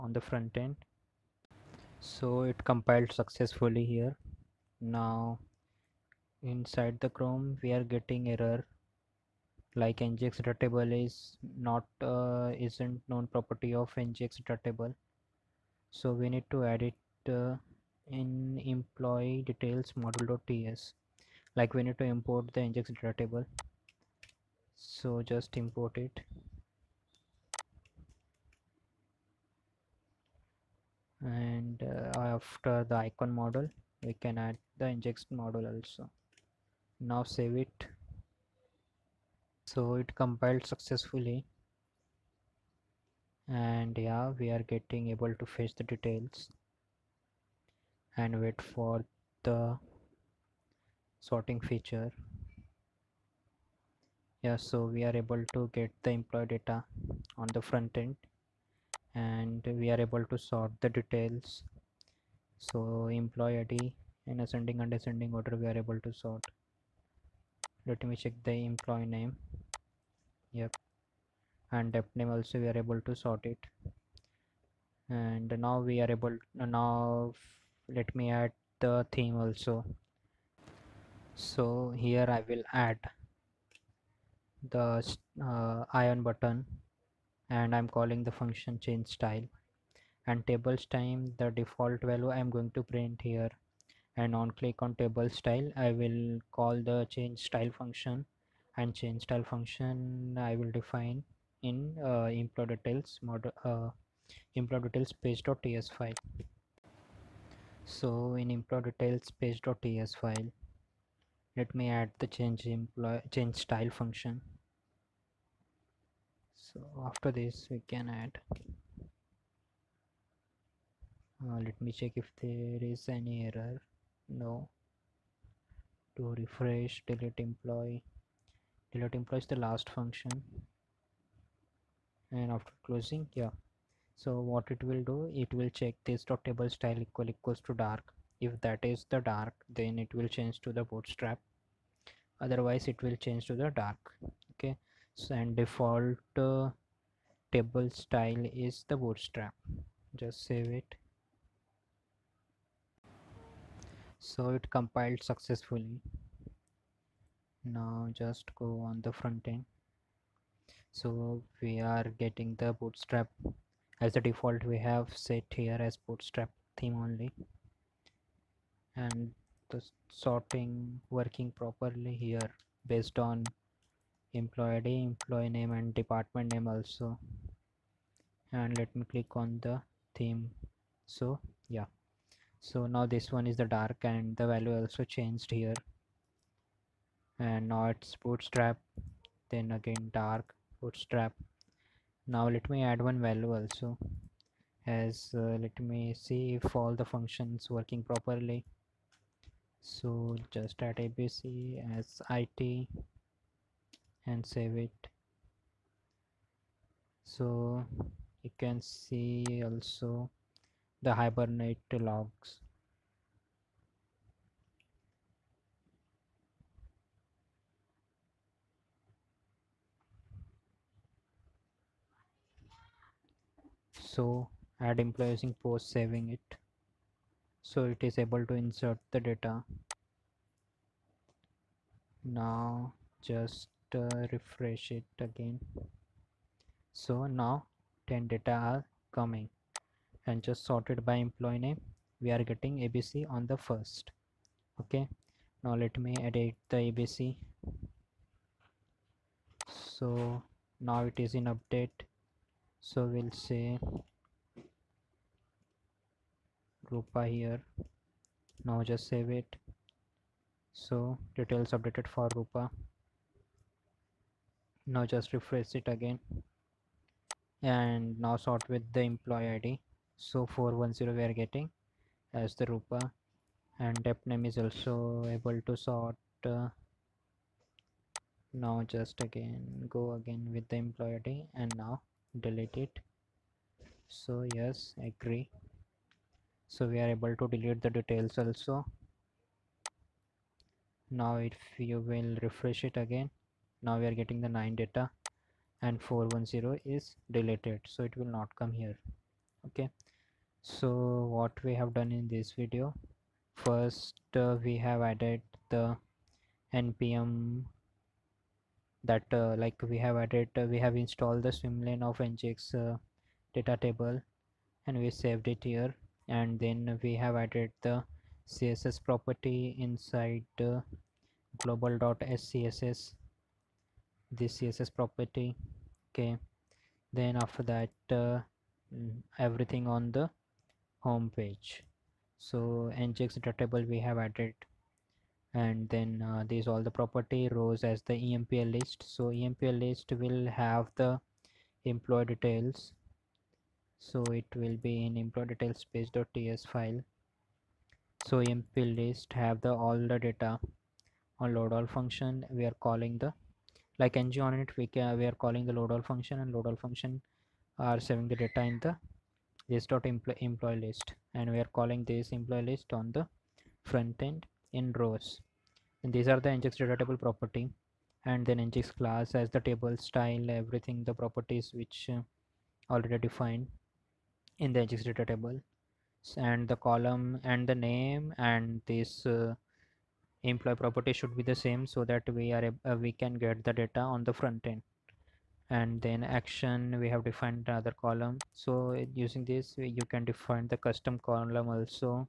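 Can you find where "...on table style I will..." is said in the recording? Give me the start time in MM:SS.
01:34.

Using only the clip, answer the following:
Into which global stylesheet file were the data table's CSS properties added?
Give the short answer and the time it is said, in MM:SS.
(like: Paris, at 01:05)
global.scss, at 05:21.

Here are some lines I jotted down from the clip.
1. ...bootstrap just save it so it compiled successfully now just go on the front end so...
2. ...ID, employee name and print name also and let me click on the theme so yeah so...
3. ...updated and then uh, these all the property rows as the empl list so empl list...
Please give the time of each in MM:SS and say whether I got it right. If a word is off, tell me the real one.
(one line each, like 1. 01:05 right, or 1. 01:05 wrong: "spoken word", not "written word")
1. 02:28 right
2. 02:54 wrong: "department", not "print"
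3. 05:34 wrong: "added", not "updated".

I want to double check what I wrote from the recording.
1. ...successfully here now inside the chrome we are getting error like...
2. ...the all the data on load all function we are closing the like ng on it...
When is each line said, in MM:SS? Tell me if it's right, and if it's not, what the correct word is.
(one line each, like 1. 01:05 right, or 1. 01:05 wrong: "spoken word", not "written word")
1. 00:03 right
2. 05:49 wrong: "calling", not "closing".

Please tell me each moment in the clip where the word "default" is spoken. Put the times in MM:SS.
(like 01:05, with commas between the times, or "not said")
01:31, 02:25, 02:44.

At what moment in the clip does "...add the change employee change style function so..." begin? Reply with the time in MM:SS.
01:51.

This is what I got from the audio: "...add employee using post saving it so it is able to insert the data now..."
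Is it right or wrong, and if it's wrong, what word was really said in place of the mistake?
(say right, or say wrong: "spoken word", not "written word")
right.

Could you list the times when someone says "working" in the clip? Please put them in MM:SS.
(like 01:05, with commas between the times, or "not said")
02:51, 03:17.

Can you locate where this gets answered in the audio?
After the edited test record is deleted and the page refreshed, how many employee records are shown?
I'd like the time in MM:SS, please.
04:54.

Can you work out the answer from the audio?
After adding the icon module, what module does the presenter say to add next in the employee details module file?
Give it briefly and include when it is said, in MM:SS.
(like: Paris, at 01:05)
injection model, at 00:34.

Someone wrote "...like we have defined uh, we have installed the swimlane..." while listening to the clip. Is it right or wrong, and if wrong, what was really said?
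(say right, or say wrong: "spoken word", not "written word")
wrong: "added", not "defined".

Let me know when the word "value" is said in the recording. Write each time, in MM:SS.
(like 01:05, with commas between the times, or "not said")
01:32, 03:04, 03:13.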